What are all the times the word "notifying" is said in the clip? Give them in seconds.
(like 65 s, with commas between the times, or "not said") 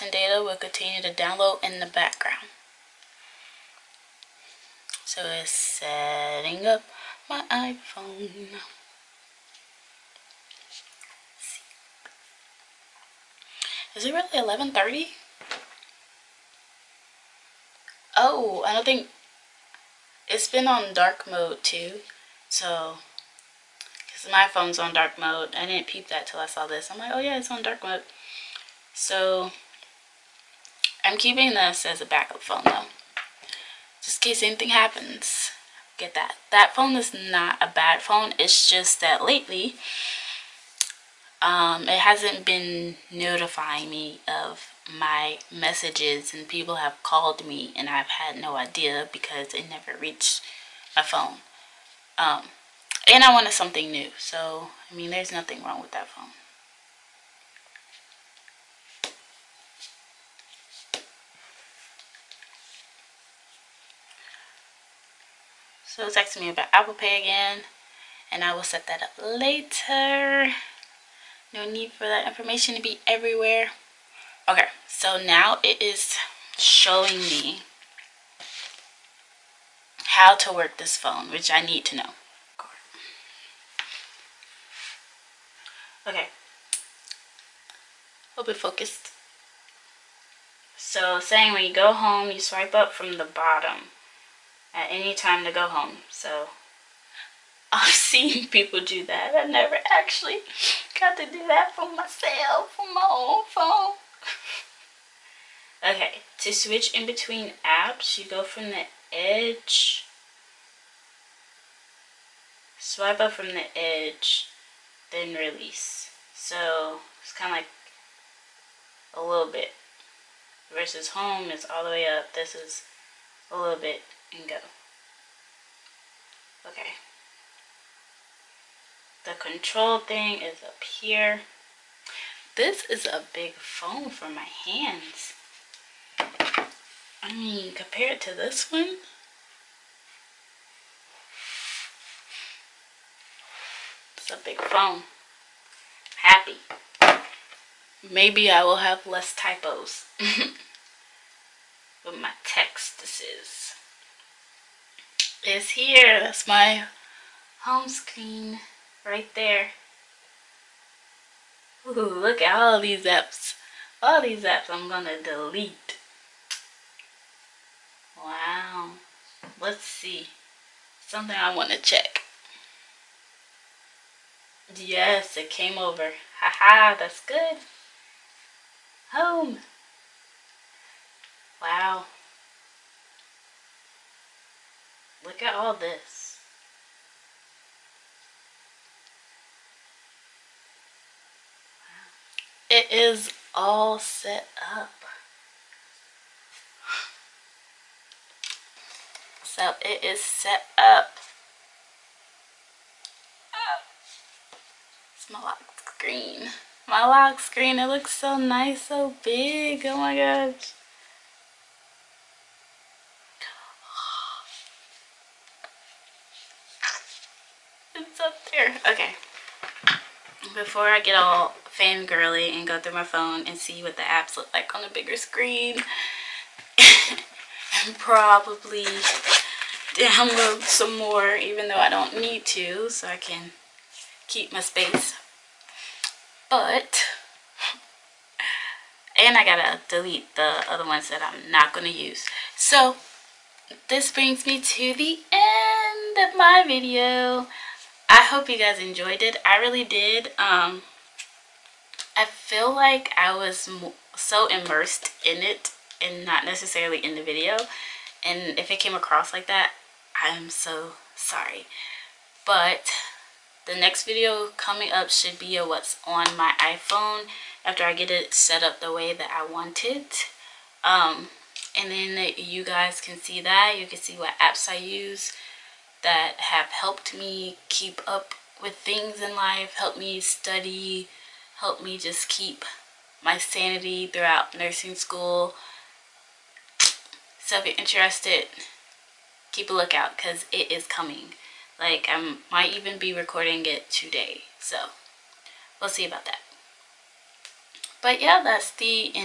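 43 s.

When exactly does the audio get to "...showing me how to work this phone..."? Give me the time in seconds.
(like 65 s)
76 s.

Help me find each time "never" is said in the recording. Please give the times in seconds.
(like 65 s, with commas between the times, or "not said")
49 s, 99 s.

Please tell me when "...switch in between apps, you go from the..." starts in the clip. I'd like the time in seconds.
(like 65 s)
106 s.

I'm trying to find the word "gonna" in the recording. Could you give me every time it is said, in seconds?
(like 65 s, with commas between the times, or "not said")
164 s, 241 s.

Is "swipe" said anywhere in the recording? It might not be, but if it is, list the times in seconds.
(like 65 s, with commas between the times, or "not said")
92 s, 112 s.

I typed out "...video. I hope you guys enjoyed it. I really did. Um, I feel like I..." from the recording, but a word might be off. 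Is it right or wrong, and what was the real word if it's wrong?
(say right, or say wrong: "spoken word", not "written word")
right.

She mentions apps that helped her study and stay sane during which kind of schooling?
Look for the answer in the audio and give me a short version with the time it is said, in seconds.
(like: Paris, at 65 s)
nursing school, at 284 s.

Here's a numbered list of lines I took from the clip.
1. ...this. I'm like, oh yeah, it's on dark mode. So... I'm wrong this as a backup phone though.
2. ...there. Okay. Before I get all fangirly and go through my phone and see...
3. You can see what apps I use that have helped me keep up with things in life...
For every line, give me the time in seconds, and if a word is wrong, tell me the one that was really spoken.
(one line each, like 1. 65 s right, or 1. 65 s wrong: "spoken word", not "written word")
1. 26 s wrong: "keeping", not "wrong"
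2. 218 s right
3. 273 s right.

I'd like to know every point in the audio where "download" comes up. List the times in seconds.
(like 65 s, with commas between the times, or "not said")
1 s, 229 s.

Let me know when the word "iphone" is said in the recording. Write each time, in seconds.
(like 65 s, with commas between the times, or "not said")
7 s, 266 s.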